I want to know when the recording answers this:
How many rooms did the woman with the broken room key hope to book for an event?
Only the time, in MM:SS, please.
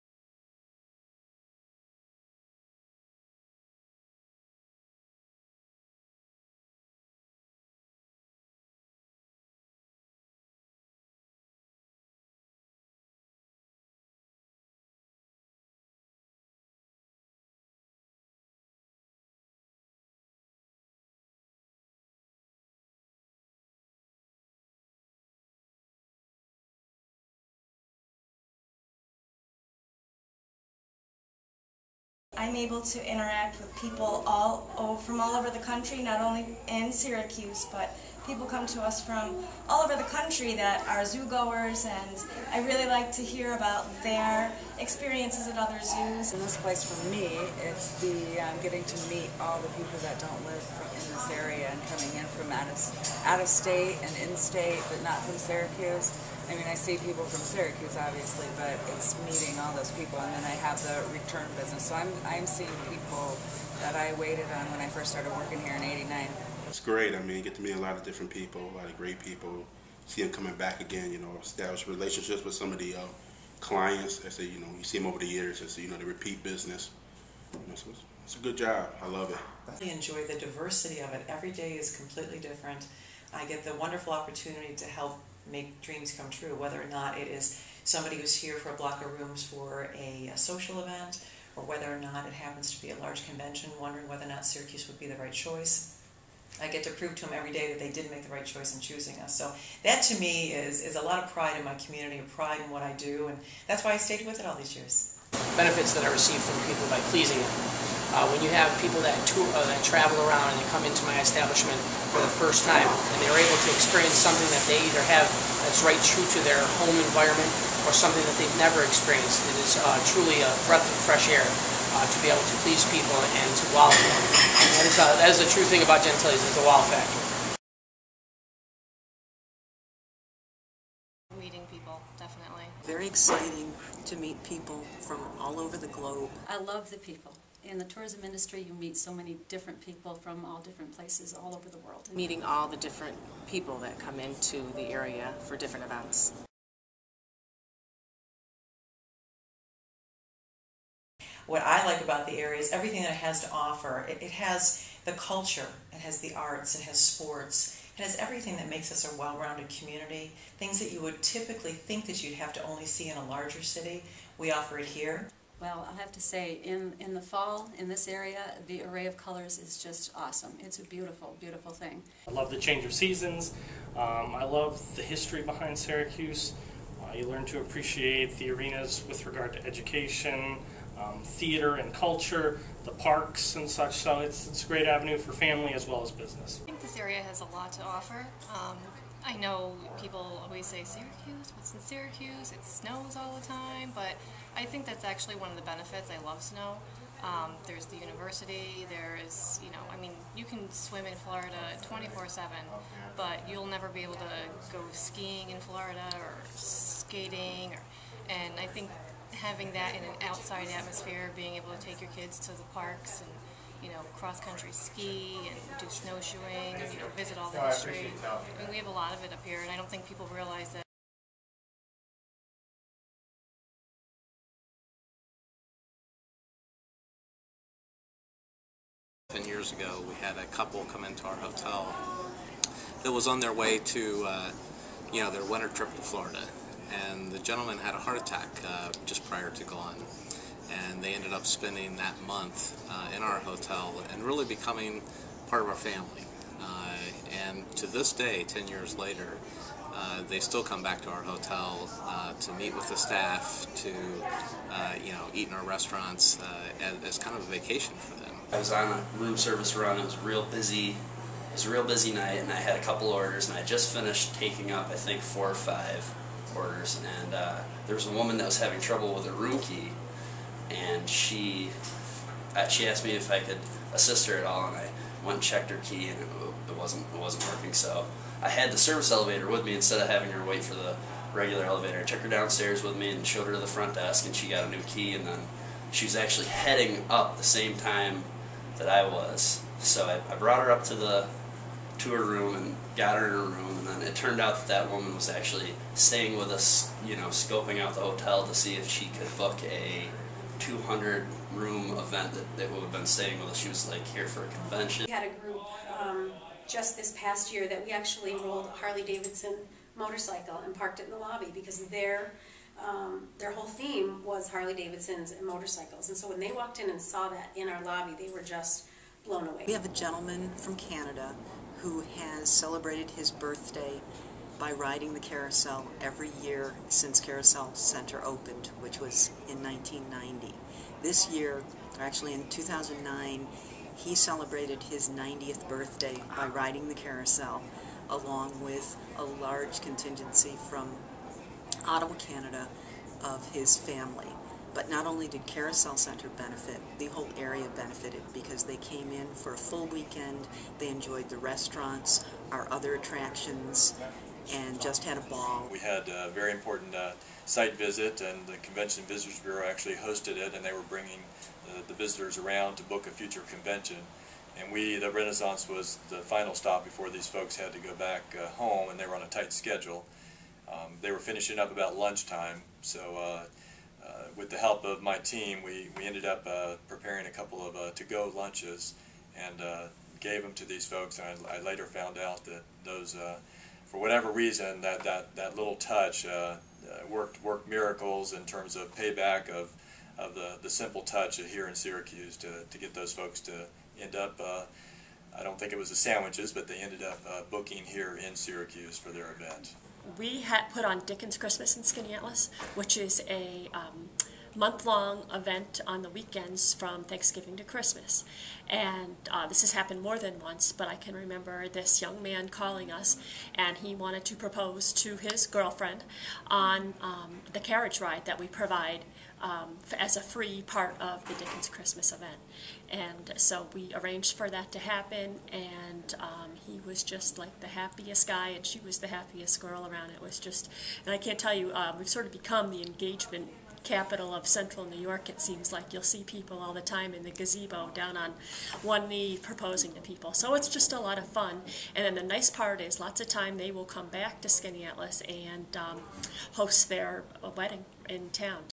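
05:00.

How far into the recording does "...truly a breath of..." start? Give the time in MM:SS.
02:00.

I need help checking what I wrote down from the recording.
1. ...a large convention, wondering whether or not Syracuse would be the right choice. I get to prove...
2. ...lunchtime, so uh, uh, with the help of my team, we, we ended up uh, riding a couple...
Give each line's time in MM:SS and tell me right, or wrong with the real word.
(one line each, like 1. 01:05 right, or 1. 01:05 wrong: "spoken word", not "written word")
1. 01:32 right
2. 06:11 wrong: "preparing", not "riding".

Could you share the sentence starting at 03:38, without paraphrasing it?
I mean, we have a lot of it up here, and I don't think people realize that.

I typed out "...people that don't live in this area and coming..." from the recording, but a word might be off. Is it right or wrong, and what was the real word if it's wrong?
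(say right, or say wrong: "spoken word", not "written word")
right.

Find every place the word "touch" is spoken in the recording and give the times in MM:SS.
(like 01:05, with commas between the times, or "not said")
06:25, 06:31.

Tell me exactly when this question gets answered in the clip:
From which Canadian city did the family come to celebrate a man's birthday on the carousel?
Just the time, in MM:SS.
05:41.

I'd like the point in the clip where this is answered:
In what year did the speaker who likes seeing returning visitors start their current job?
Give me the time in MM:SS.
01:05.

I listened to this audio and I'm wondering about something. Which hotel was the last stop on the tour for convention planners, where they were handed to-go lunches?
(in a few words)
The Renaissance.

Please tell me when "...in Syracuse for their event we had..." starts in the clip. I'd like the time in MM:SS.
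06:38.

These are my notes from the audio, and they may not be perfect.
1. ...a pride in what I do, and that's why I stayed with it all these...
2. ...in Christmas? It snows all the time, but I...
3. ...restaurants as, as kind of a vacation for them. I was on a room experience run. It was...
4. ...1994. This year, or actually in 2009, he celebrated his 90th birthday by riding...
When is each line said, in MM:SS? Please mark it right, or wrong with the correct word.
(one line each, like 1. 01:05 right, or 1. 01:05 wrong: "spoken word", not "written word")
1. 01:42 right
2. 03:11 wrong: "Syracuse", not "Christmas"
3. 04:15 wrong: "service", not "experience"
4. 05:29 wrong: "1990", not "1994".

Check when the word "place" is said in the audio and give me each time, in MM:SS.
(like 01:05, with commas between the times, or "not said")
00:46, 02:20.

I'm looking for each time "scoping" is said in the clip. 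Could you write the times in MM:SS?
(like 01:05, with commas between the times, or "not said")
04:57.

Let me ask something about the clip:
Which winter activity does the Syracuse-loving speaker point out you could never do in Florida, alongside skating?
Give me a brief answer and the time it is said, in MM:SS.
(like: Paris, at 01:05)
Skiing, at 03:24.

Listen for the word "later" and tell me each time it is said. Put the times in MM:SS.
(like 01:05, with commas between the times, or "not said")
04:08, 06:21.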